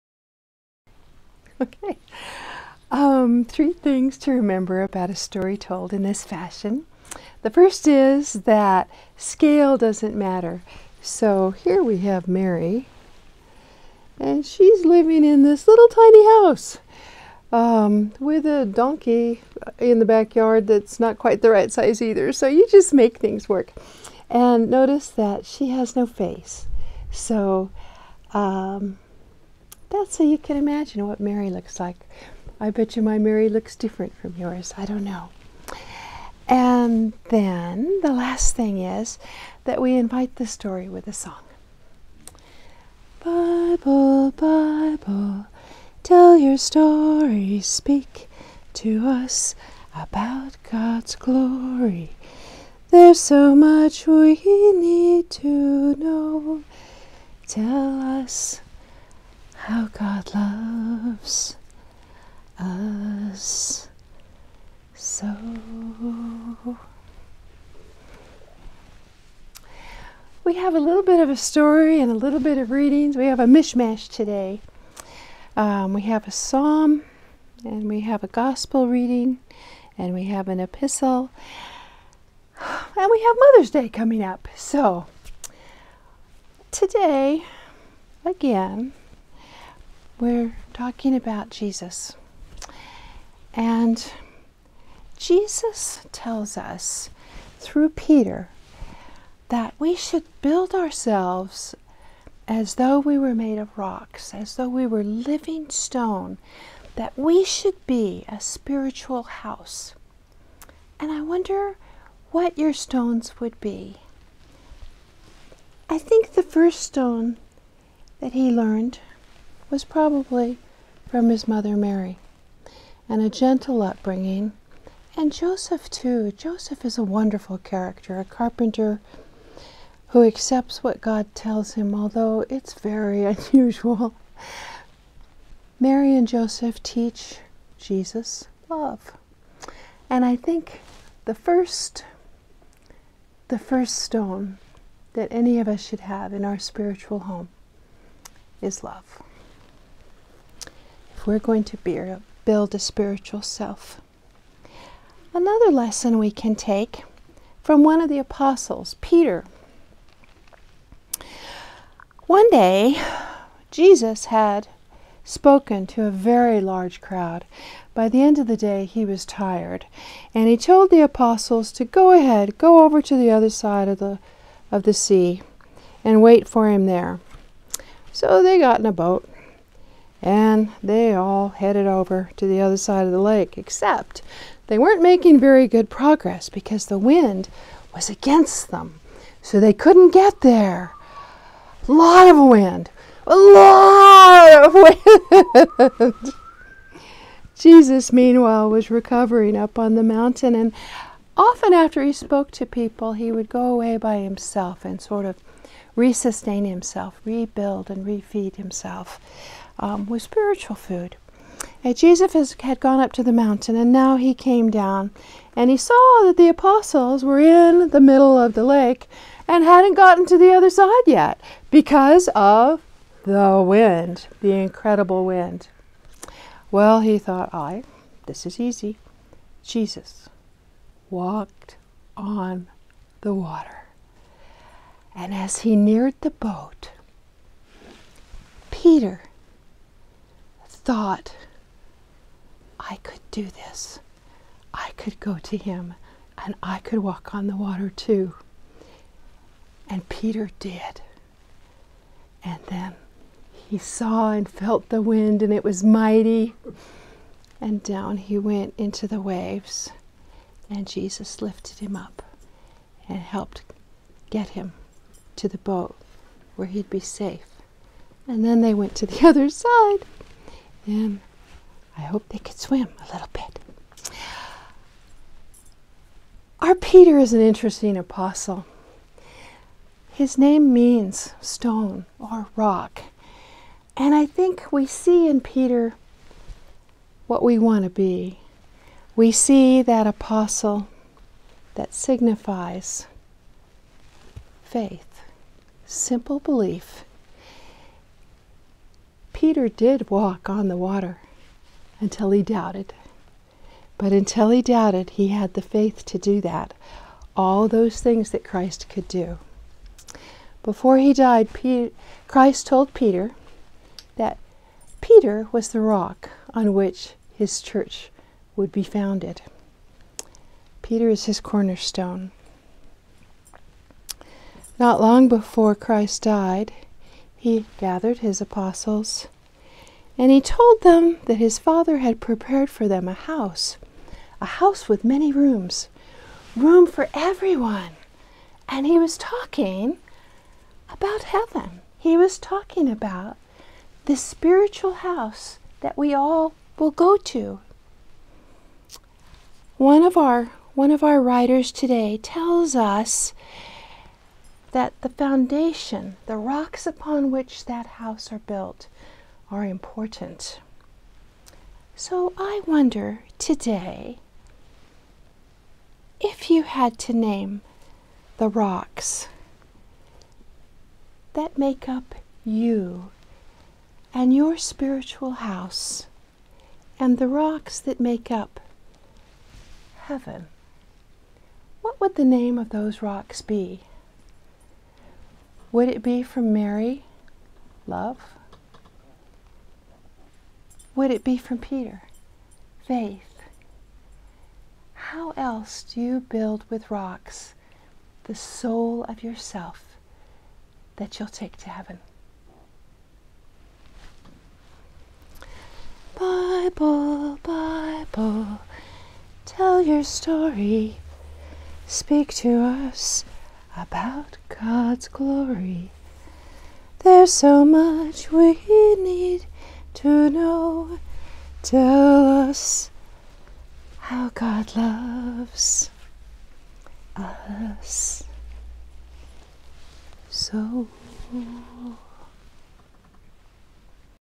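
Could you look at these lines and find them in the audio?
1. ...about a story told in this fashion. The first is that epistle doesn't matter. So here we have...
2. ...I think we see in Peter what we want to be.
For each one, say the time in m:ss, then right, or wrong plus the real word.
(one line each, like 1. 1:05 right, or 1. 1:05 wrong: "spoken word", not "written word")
1. 0:04 wrong: "scale", not "epistle"
2. 4:44 right.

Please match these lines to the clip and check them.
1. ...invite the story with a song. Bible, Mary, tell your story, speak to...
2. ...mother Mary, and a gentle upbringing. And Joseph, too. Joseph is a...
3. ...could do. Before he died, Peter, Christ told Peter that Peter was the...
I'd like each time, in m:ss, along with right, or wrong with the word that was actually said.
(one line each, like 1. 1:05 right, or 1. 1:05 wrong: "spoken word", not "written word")
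1. 0:39 wrong: "Bible", not "Mary"
2. 2:01 right
3. 5:08 right.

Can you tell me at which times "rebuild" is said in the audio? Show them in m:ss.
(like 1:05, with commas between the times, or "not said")
3:27.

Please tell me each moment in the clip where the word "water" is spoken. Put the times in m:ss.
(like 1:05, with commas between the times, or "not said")
3:53, 4:07, 5:00.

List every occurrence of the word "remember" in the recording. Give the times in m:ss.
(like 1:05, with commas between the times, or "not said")
0:04.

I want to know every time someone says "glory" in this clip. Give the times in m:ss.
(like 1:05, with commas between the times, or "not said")
0:51, 6:55.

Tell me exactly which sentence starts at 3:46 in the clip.
Well, he thought, I, this is easy.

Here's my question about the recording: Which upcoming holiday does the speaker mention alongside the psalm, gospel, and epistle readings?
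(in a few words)
Mother's Day.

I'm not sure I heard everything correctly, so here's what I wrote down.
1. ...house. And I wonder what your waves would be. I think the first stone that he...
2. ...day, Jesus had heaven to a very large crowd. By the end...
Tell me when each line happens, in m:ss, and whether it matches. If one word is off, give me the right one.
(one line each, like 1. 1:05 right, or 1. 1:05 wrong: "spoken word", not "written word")
1. 1:49 wrong: "stones", not "waves"
2. 2:42 wrong: "spoken", not "heaven".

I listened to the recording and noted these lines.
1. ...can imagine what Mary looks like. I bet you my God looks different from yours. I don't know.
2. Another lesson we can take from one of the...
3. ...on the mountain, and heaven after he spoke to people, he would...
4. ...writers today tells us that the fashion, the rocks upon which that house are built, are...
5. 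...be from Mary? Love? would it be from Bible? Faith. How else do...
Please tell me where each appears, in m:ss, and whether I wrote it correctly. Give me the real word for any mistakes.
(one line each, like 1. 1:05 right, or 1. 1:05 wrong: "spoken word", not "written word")
1. 0:30 wrong: "Mary", not "God"
2. 2:35 right
3. 3:19 wrong: "often", not "heaven"
4. 5:51 wrong: "foundation", not "fashion"
5. 6:26 wrong: "Peter", not "Bible".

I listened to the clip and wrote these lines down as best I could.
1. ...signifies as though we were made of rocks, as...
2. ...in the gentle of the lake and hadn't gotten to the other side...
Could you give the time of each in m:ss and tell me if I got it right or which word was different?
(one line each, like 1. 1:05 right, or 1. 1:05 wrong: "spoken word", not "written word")
1. 1:40 wrong: "ourselves", not "signifies"
2. 3:37 wrong: "middle", not "gentle".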